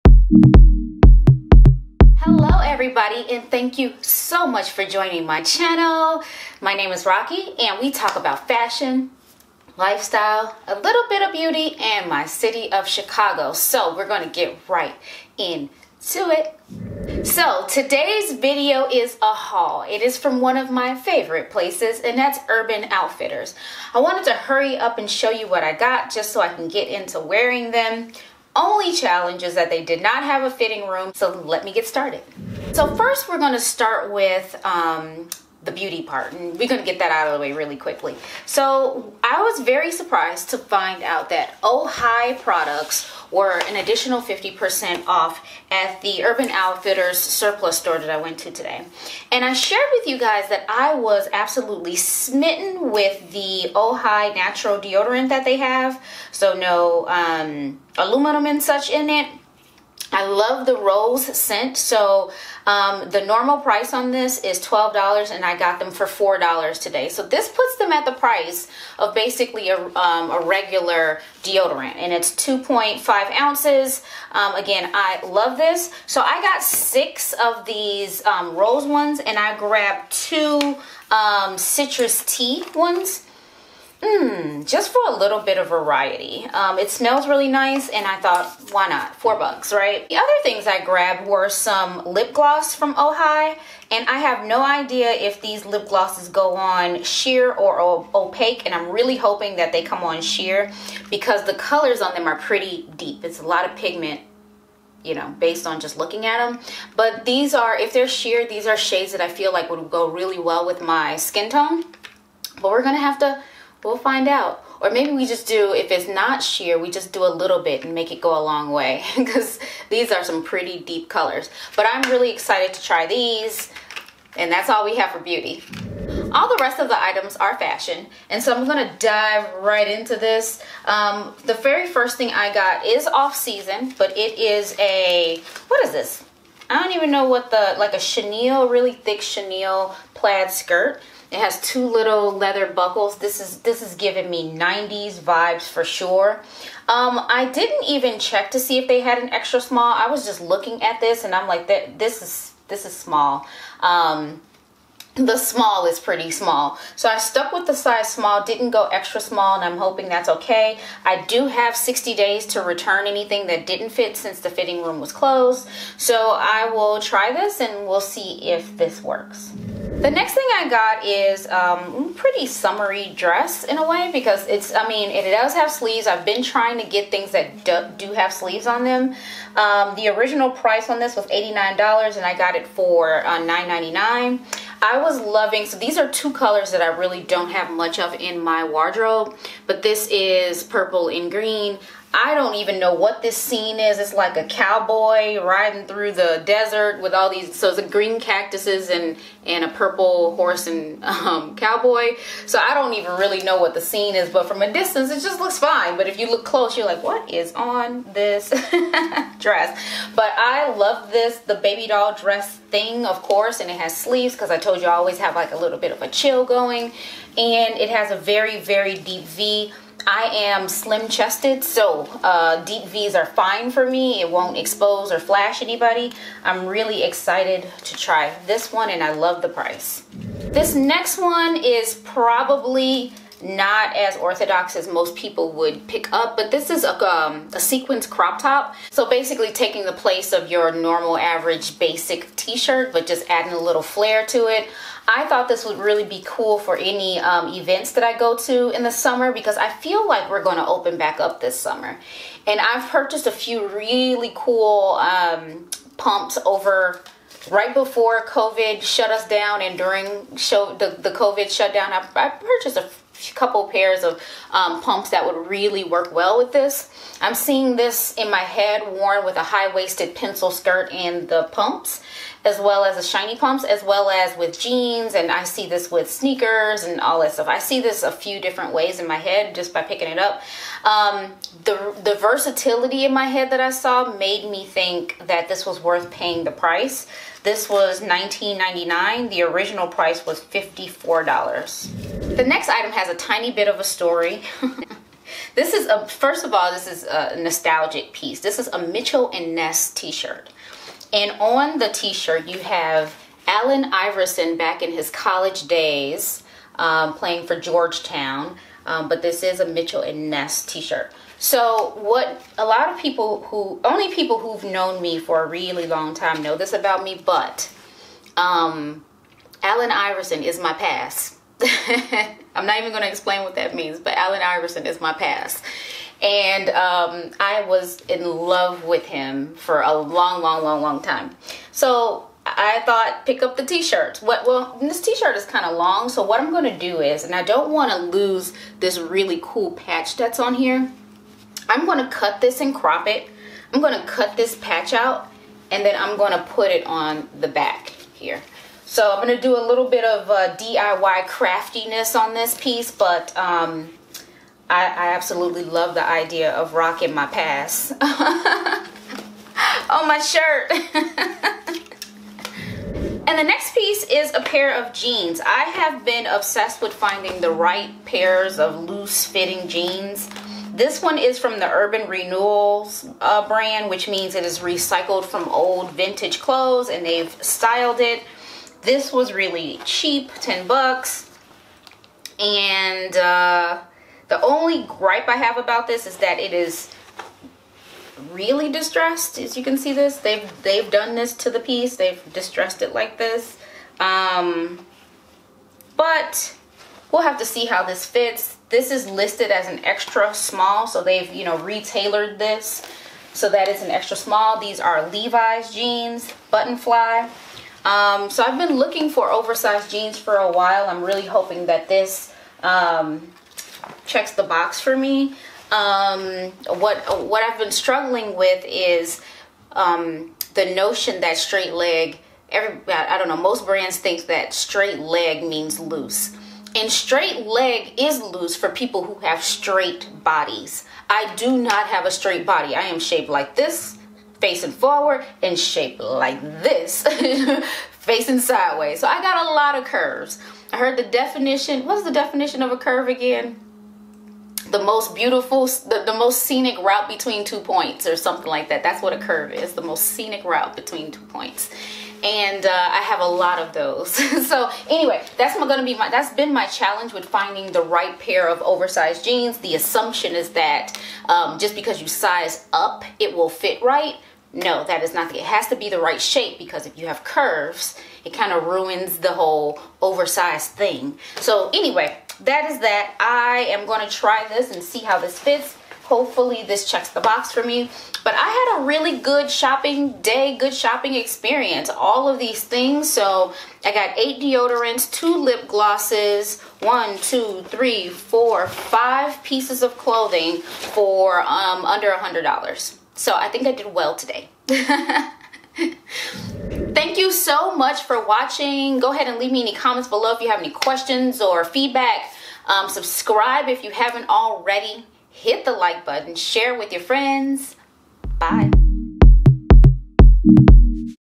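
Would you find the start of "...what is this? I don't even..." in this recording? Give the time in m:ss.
2:15.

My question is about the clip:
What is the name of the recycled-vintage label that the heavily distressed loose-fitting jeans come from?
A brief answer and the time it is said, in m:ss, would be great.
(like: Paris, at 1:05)
Urban Renewals, at 6:11.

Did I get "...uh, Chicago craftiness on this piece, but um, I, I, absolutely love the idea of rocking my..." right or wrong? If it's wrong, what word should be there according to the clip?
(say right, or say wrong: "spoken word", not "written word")
wrong: "DIY", not "Chicago".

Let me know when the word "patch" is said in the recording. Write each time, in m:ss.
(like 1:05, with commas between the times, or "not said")
5:39, 5:44.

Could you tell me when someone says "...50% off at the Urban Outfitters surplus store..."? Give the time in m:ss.
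0:44.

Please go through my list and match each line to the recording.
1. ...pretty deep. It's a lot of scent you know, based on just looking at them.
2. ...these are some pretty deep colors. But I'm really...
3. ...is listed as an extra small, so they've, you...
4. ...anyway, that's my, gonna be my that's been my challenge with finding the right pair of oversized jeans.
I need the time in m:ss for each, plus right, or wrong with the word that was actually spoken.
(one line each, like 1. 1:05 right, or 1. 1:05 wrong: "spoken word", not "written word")
1. 1:42 wrong: "pigment", not "scent"
2. 1:59 right
3. 6:38 right
4. 7:34 right.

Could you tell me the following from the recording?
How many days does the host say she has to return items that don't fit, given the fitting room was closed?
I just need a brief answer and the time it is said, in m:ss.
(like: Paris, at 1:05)
60, at 2:41.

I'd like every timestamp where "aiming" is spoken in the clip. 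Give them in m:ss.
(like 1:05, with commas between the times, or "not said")
not said.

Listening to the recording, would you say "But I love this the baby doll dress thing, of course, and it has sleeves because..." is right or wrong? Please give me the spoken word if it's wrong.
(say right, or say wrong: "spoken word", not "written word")
right.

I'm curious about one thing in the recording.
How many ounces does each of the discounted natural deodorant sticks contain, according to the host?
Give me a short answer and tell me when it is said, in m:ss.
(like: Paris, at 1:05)
2.5, at 1:12.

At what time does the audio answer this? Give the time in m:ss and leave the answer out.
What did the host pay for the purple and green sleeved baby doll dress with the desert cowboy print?
3:03.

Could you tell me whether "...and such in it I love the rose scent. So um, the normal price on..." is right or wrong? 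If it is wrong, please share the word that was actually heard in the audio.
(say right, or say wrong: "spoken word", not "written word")
right.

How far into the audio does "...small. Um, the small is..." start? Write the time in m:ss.
2:32.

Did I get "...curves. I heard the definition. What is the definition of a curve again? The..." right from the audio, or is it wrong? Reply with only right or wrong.
right.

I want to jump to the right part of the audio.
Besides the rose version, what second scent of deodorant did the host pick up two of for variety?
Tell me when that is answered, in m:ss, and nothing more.
1:21.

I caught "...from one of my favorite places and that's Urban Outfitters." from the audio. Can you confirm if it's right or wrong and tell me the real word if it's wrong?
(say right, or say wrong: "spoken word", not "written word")
right.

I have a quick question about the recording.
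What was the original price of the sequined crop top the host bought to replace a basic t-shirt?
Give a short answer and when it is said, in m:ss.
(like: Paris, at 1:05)
$54, at 4:50.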